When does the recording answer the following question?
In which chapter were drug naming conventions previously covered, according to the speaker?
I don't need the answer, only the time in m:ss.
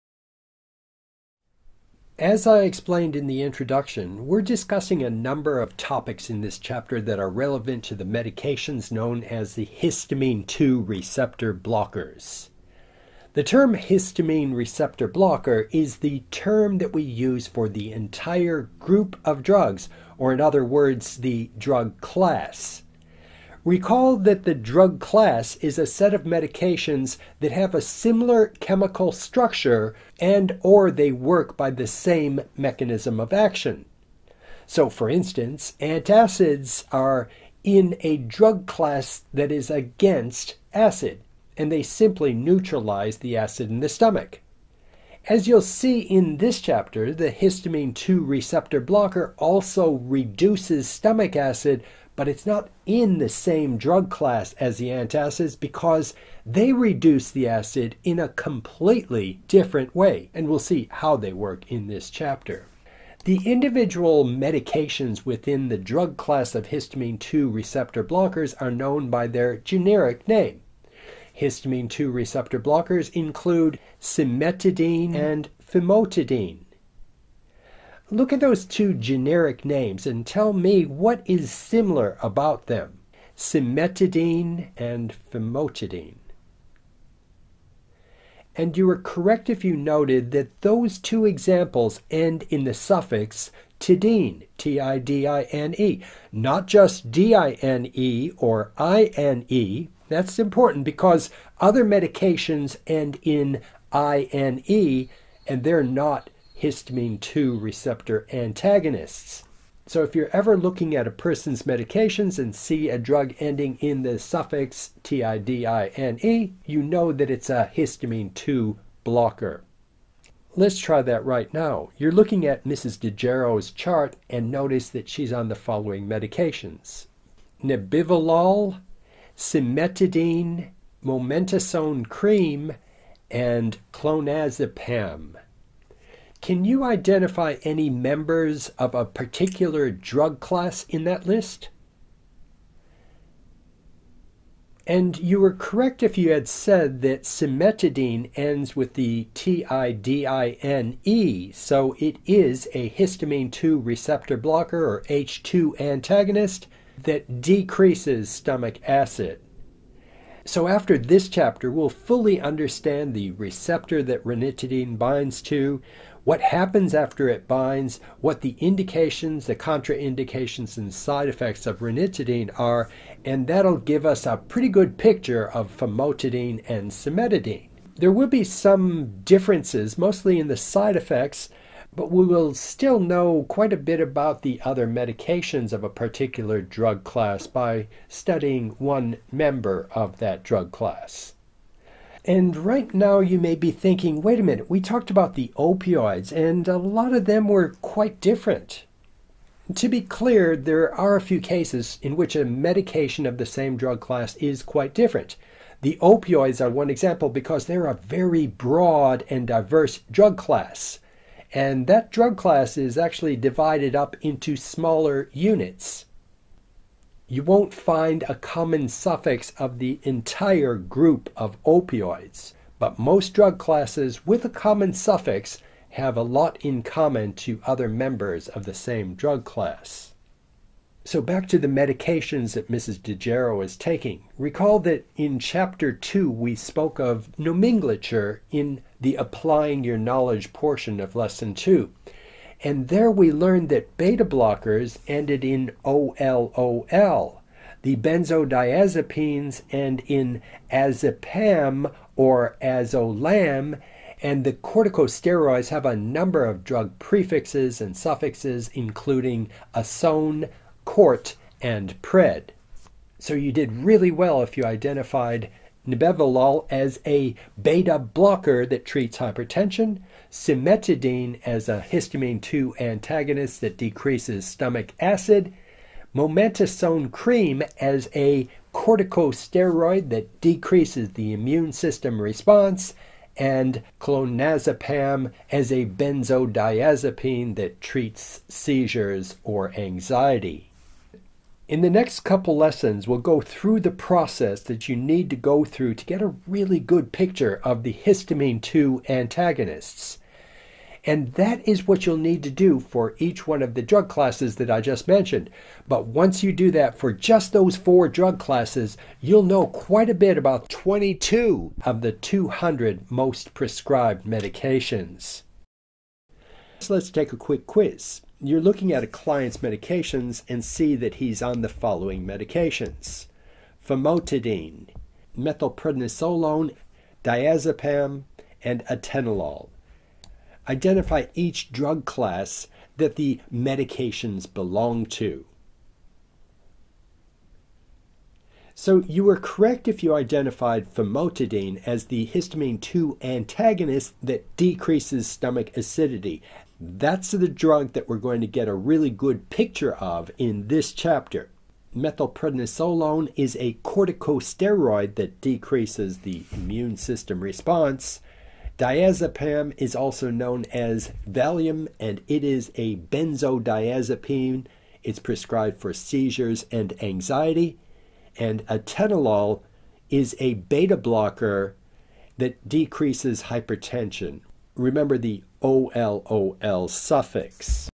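3:55.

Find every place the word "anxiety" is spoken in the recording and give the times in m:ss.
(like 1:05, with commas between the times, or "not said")
4:49, 6:07.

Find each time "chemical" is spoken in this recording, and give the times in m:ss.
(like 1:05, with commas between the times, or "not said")
0:28.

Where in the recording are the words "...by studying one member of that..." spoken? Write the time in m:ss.
3:07.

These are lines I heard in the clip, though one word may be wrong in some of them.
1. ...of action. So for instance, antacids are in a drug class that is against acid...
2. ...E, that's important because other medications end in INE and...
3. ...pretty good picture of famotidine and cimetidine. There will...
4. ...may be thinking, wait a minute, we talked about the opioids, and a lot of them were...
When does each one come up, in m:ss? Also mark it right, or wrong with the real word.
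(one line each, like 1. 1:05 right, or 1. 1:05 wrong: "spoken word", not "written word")
1. 0:33 right
2. 1:39 right
3. 2:54 right
4. 3:13 right.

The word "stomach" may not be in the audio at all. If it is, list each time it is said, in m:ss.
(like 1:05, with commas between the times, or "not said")
0:43, 0:50, 2:38, 4:34, 5:45.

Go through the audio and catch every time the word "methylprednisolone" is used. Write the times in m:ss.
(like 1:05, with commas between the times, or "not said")
5:25, 5:51.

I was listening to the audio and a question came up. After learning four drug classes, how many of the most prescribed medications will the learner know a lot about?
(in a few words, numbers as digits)
22.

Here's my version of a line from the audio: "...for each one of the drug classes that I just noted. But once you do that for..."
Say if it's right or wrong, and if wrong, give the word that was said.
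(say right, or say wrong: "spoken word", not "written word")
wrong: "mentioned", not "noted".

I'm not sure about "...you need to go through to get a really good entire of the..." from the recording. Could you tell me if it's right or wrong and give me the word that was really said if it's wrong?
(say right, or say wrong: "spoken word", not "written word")
wrong: "picture", not "entire".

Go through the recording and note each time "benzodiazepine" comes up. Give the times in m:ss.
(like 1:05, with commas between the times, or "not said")
4:07, 4:45, 6:02.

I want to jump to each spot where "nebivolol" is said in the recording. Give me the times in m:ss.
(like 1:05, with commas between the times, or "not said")
2:07, 4:25.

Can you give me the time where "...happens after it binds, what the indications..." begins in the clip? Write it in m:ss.
2:46.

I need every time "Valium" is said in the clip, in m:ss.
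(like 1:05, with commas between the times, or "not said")
6:01.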